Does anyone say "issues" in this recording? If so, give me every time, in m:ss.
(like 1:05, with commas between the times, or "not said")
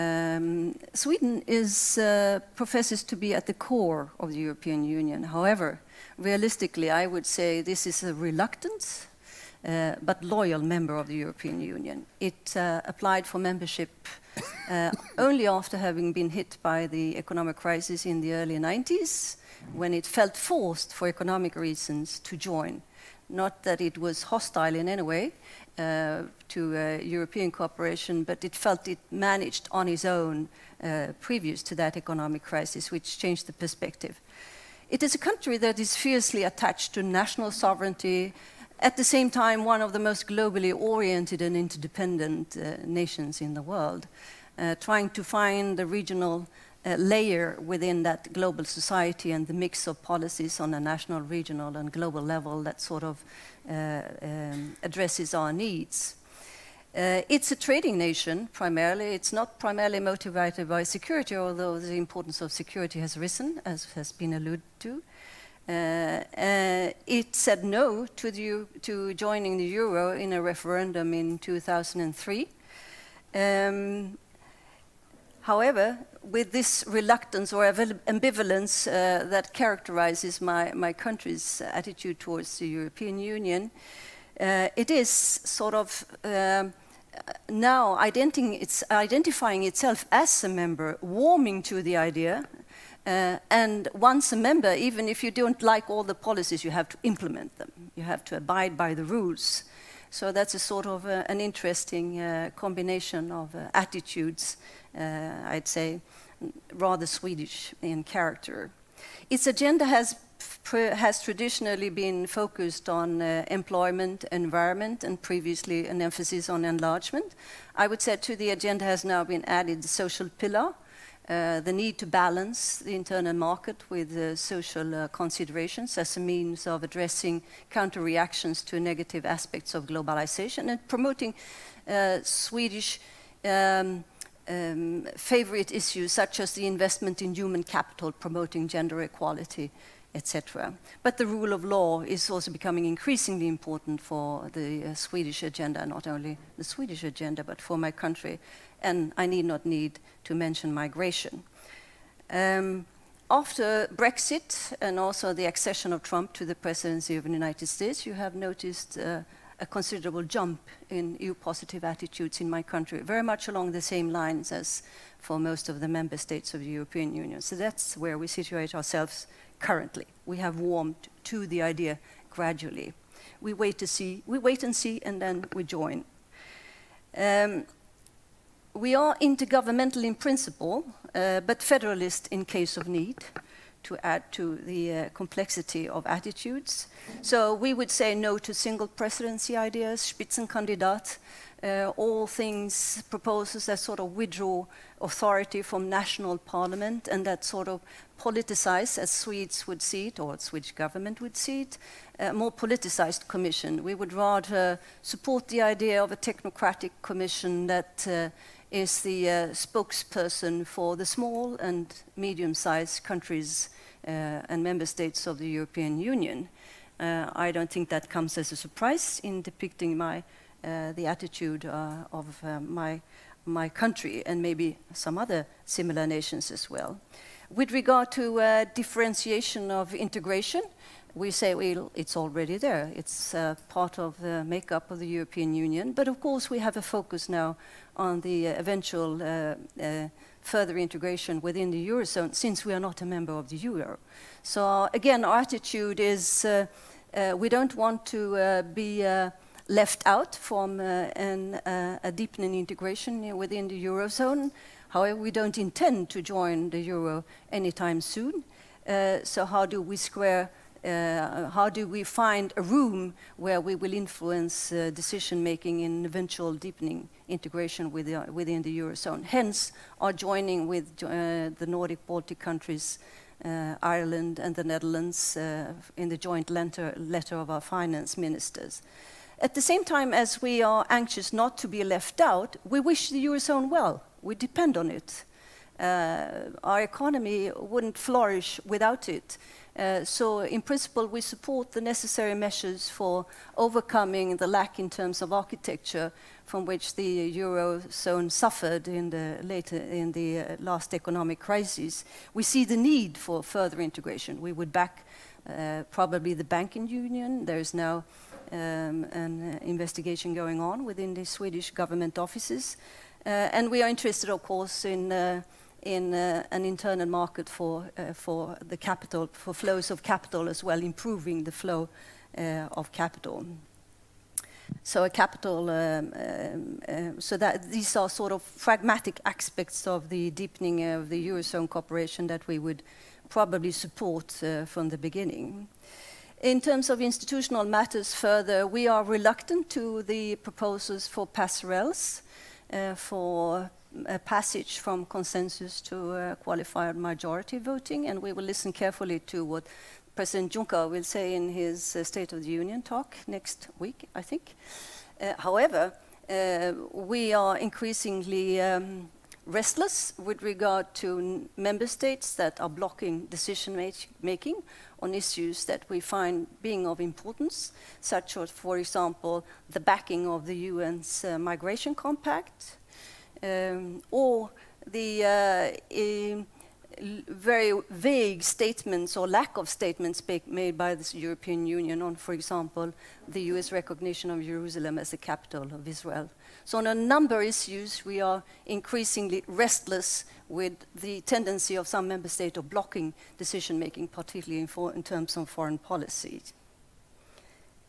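2:15, 6:05, 6:27.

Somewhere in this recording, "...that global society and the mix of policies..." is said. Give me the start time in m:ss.
0:48.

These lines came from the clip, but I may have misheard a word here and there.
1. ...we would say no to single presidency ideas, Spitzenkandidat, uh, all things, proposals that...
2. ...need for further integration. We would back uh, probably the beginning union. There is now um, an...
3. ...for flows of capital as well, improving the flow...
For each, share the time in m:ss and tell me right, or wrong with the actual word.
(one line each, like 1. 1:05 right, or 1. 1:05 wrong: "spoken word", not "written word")
1. 3:07 right
2. 5:02 wrong: "banking", not "beginning"
3. 5:19 right.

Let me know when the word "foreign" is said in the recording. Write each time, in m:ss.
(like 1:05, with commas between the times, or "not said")
6:35.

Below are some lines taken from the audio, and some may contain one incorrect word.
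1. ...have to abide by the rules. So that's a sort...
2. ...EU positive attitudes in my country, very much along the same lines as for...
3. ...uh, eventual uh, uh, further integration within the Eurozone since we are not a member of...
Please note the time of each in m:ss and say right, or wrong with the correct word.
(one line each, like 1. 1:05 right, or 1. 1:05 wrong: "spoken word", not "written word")
1. 1:38 right
2. 2:41 right
3. 3:58 right.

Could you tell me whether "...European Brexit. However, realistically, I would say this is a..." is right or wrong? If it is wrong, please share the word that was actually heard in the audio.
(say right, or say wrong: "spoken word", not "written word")
wrong: "Union", not "Brexit".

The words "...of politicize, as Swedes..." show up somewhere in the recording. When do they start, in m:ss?
3:17.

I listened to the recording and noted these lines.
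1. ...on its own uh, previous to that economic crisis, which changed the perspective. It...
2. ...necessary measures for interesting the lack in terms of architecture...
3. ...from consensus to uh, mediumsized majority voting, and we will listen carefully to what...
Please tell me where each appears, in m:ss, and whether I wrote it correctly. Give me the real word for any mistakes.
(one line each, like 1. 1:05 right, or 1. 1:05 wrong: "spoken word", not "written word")
1. 0:29 right
2. 4:51 wrong: "overcoming", not "interesting"
3. 5:44 wrong: "qualified", not "mediumsized".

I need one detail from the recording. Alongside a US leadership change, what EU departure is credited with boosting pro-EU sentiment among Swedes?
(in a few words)
Brexit.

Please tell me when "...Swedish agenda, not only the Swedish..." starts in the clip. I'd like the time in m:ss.
2:24.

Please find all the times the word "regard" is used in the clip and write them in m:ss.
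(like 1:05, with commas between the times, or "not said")
3:47, 6:00.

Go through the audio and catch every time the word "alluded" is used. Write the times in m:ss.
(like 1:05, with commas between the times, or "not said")
1:04.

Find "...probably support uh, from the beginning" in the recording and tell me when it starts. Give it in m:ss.
5:33.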